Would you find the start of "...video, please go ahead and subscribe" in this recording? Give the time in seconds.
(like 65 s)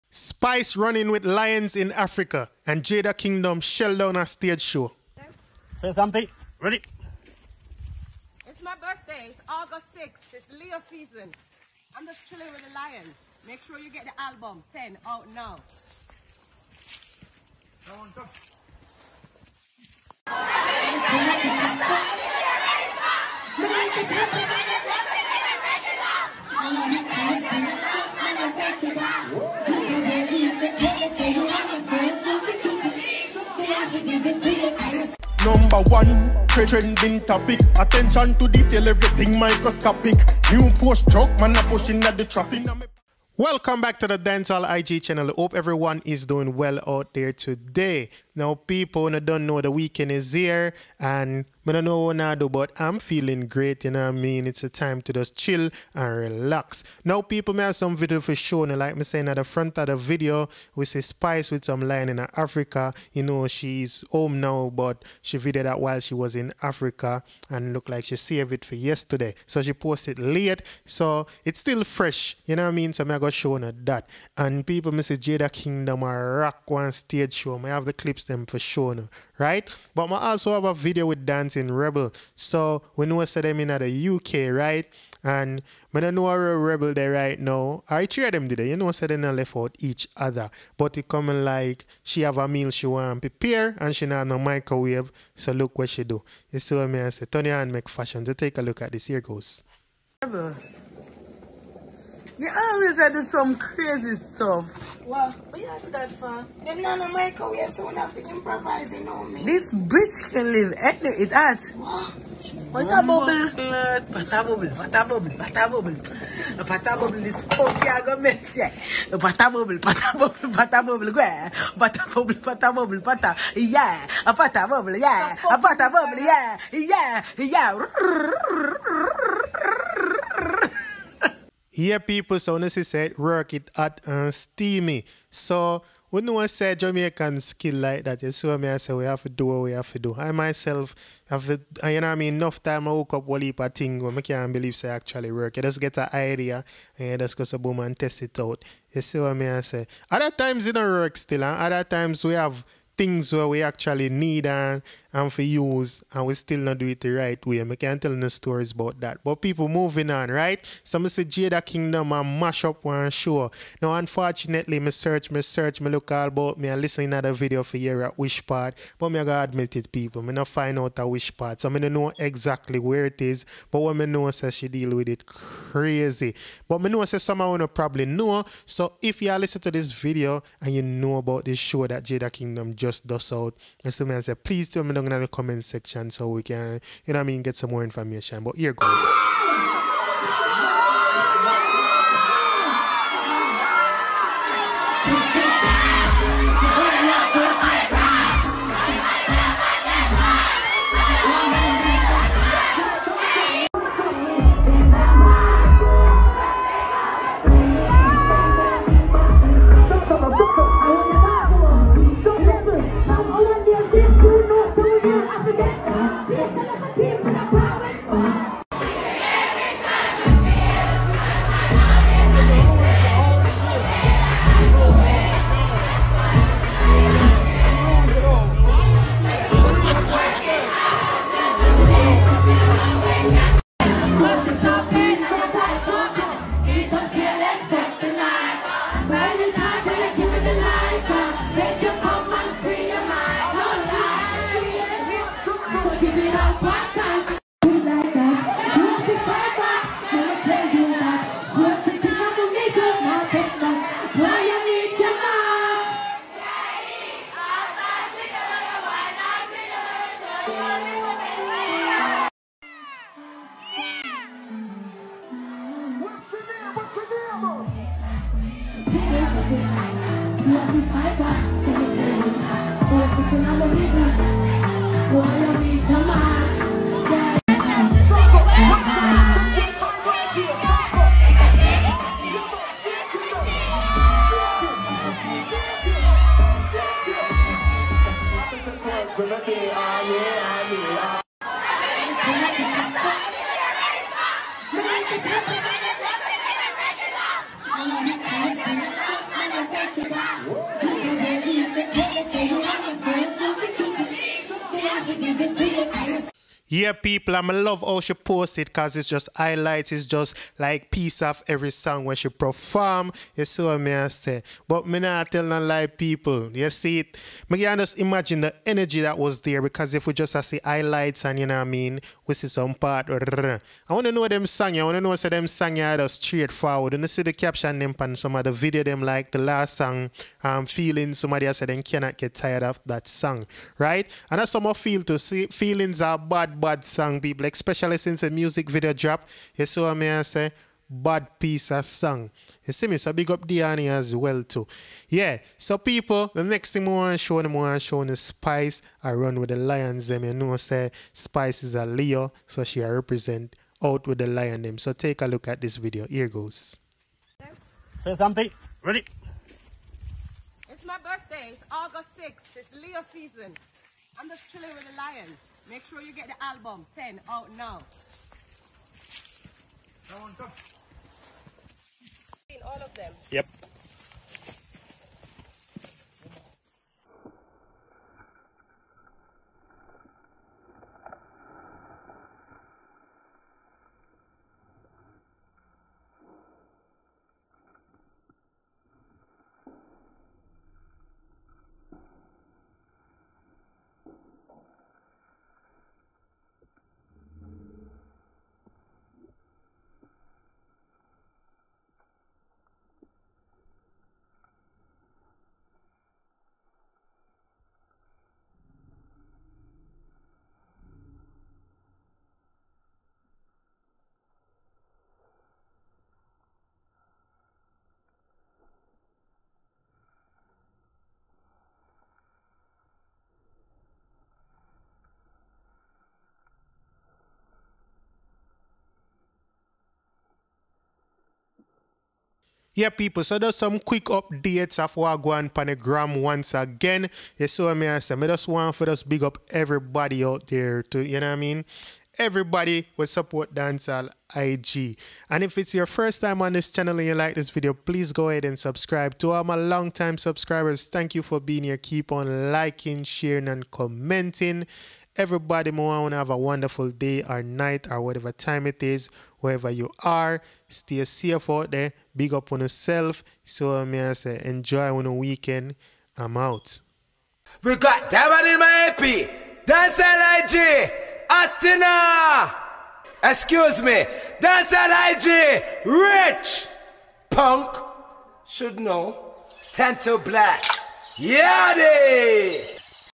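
447 s.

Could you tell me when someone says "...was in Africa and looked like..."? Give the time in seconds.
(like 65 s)
66 s.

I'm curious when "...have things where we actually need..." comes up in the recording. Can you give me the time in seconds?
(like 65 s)
152 s.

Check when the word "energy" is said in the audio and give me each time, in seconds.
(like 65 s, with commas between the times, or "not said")
318 s.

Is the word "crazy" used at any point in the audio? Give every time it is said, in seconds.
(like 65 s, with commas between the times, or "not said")
103 s, 175 s.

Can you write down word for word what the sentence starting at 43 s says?
Welcome back to the Dancehall IG channel.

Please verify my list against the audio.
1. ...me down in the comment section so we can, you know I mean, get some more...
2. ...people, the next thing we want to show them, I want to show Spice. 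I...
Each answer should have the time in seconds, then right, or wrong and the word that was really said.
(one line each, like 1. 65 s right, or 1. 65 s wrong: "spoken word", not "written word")
1. 184 s right
2. 345 s right.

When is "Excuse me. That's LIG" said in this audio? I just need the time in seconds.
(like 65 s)
473 s.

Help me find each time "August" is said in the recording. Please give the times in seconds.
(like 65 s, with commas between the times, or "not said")
9 s, 361 s.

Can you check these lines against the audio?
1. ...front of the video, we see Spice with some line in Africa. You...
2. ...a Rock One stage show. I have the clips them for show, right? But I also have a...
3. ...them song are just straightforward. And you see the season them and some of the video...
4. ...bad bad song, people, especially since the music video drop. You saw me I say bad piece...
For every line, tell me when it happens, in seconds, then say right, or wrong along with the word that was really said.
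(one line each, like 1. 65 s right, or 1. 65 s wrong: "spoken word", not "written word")
1. 59 s right
2. 76 s right
3. 325 s wrong: "caption", not "season"
4. 336 s right.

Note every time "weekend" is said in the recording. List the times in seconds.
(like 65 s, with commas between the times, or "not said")
49 s, 465 s.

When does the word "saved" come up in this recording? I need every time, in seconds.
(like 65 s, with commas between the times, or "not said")
68 s.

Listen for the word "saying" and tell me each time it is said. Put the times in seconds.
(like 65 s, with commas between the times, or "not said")
59 s.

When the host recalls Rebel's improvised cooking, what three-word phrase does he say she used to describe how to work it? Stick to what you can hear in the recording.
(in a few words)
hot and steamy.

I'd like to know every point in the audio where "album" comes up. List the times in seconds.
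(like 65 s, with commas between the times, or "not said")
14 s, 366 s.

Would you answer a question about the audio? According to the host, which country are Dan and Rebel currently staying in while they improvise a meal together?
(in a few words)
UK.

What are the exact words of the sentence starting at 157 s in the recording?
I can't tell no stories about that.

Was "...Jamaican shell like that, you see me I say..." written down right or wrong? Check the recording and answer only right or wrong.
wrong.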